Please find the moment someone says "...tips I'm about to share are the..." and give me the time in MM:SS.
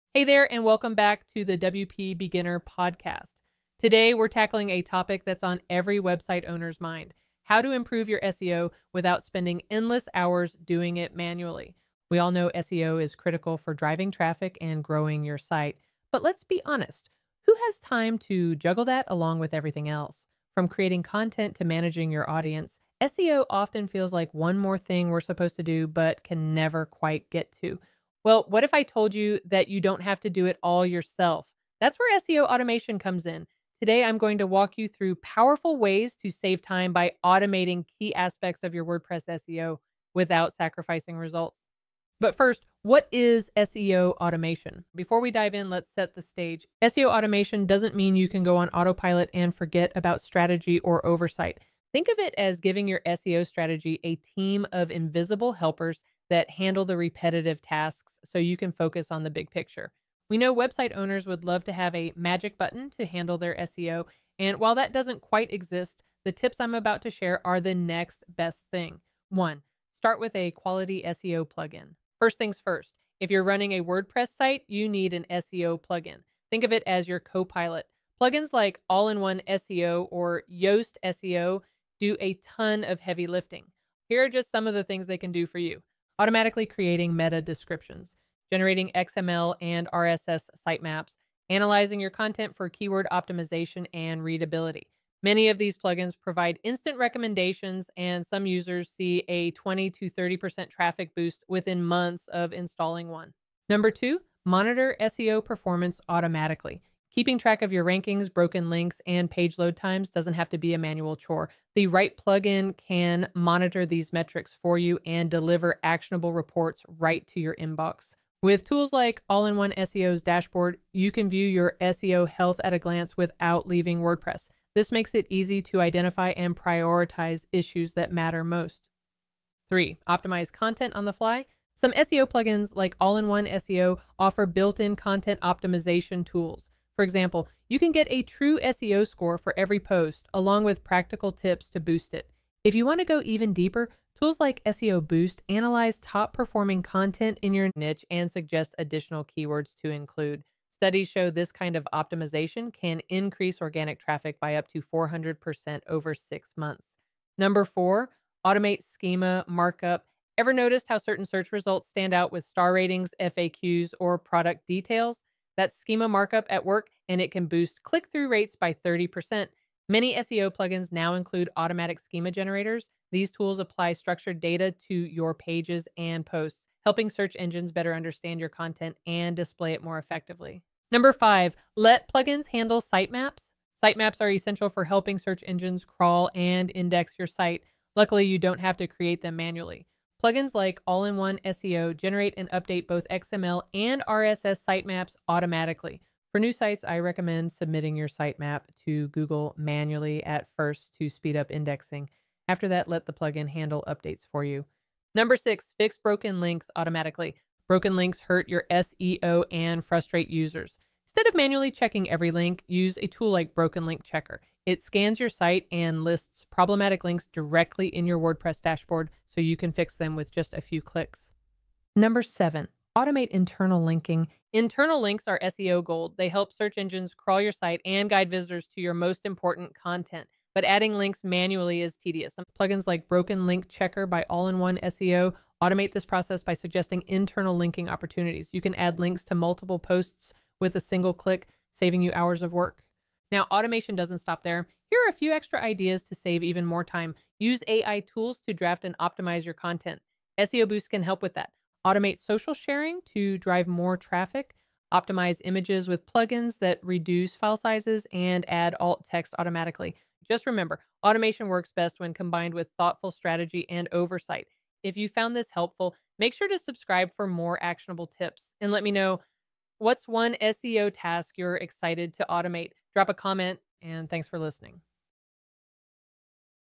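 01:06.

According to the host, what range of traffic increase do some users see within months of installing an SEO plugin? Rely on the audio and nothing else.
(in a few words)
20 to 30%.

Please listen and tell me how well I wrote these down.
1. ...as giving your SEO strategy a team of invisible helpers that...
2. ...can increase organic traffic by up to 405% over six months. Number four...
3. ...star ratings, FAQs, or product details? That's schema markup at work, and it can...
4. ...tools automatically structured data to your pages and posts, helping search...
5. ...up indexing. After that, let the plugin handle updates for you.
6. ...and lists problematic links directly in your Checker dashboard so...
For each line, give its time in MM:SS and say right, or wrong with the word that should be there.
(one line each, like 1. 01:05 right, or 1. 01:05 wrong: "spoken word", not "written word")
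1. 00:52 right
2. 02:32 wrong: "400", not "405"
3. 02:42 right
4. 02:53 wrong: "apply", not "automatically"
5. 03:21 right
6. 03:35 wrong: "WordPress", not "Checker".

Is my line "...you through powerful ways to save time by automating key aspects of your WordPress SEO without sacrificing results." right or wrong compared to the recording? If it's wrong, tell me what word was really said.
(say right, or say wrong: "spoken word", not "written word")
right.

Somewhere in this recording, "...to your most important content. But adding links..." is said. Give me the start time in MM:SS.
03:48.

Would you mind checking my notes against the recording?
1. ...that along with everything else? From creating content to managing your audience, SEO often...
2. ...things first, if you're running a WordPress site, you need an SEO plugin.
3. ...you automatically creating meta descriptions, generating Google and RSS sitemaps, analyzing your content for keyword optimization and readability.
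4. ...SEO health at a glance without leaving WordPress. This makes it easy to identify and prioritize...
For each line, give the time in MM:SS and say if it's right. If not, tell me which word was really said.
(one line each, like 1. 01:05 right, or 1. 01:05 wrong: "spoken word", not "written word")
1. 00:18 right
2. 01:12 right
3. 01:25 wrong: "XML", not "Google"
4. 02:01 right.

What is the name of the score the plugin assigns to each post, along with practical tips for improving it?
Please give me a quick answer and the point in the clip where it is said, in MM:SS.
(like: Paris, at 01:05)
TruSEO, at 02:18.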